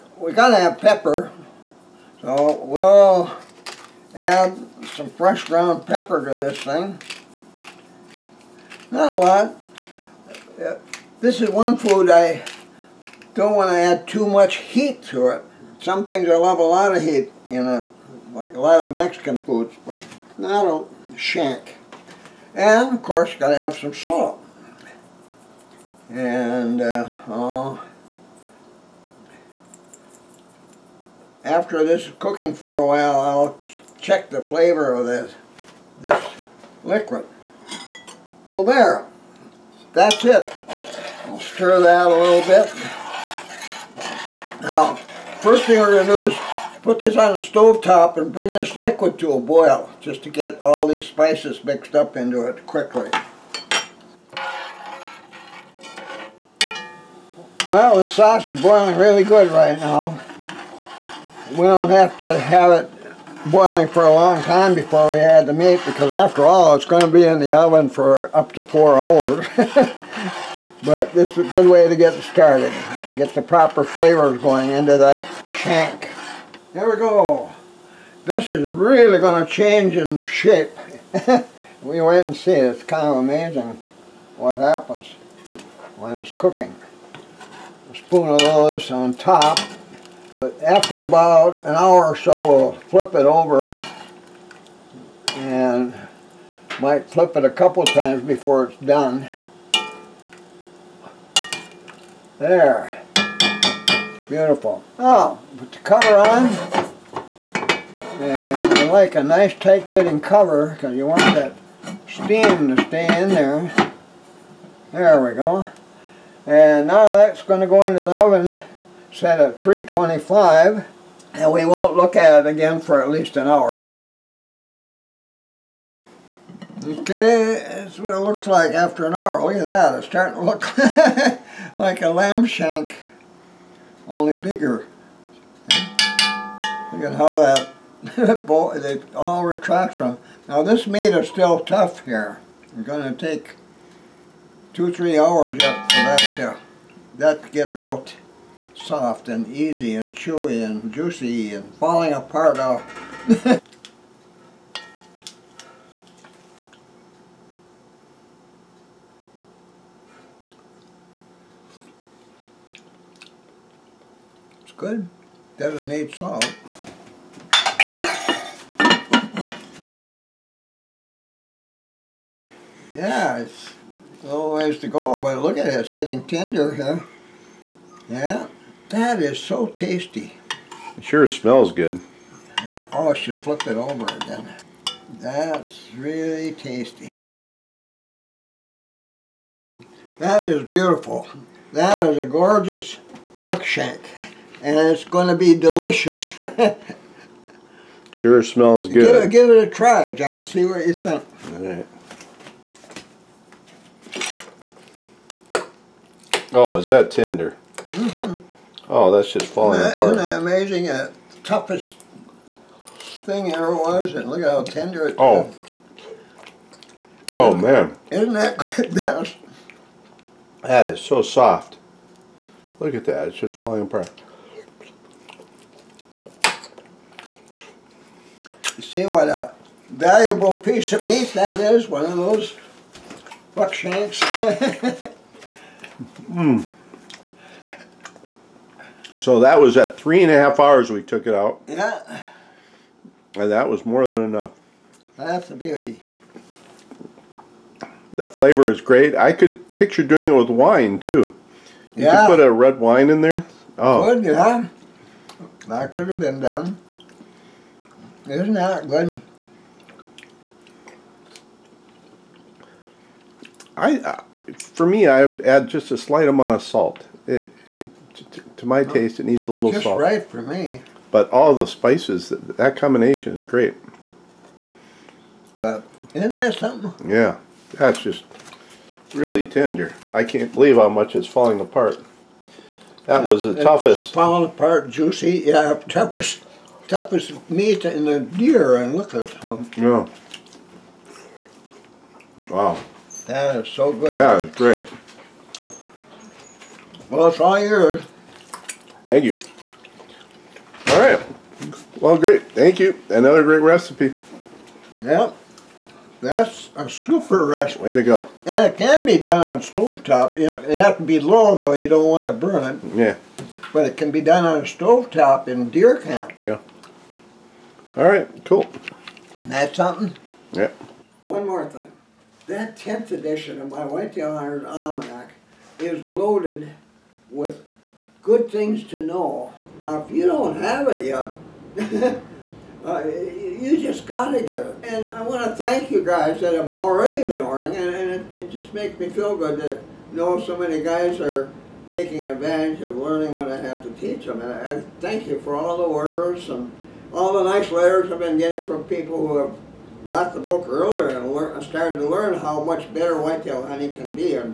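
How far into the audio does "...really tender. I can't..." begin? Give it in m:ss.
4:39.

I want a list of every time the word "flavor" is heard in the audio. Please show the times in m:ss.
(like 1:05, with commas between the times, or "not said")
0:34, 1:13, 4:08.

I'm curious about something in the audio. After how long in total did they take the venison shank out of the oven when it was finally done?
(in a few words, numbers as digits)
three and a half hours.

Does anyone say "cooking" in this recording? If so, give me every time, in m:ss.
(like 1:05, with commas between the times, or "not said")
0:32, 1:26.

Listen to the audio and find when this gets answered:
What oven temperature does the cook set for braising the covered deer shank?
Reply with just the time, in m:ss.
1:59.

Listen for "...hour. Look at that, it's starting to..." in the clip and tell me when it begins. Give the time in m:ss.
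2:09.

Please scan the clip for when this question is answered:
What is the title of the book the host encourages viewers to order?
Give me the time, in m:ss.
5:23.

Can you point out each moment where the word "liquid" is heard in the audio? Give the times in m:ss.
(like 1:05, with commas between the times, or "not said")
0:36, 0:48.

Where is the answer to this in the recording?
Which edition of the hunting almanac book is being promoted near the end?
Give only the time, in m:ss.
5:22.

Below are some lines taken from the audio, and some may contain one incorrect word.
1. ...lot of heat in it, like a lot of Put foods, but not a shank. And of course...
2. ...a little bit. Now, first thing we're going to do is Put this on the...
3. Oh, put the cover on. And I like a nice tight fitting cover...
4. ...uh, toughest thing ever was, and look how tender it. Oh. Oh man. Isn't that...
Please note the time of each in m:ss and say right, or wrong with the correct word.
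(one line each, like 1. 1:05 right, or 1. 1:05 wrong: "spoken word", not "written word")
1. 0:16 wrong: "Mexican", not "Put"
2. 0:42 right
3. 1:44 right
4. 3:31 right.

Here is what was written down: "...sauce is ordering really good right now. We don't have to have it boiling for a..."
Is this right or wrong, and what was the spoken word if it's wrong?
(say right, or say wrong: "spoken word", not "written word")
wrong: "boiling", not "ordering".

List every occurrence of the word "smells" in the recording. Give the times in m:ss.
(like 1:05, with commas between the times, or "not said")
3:01, 3:18.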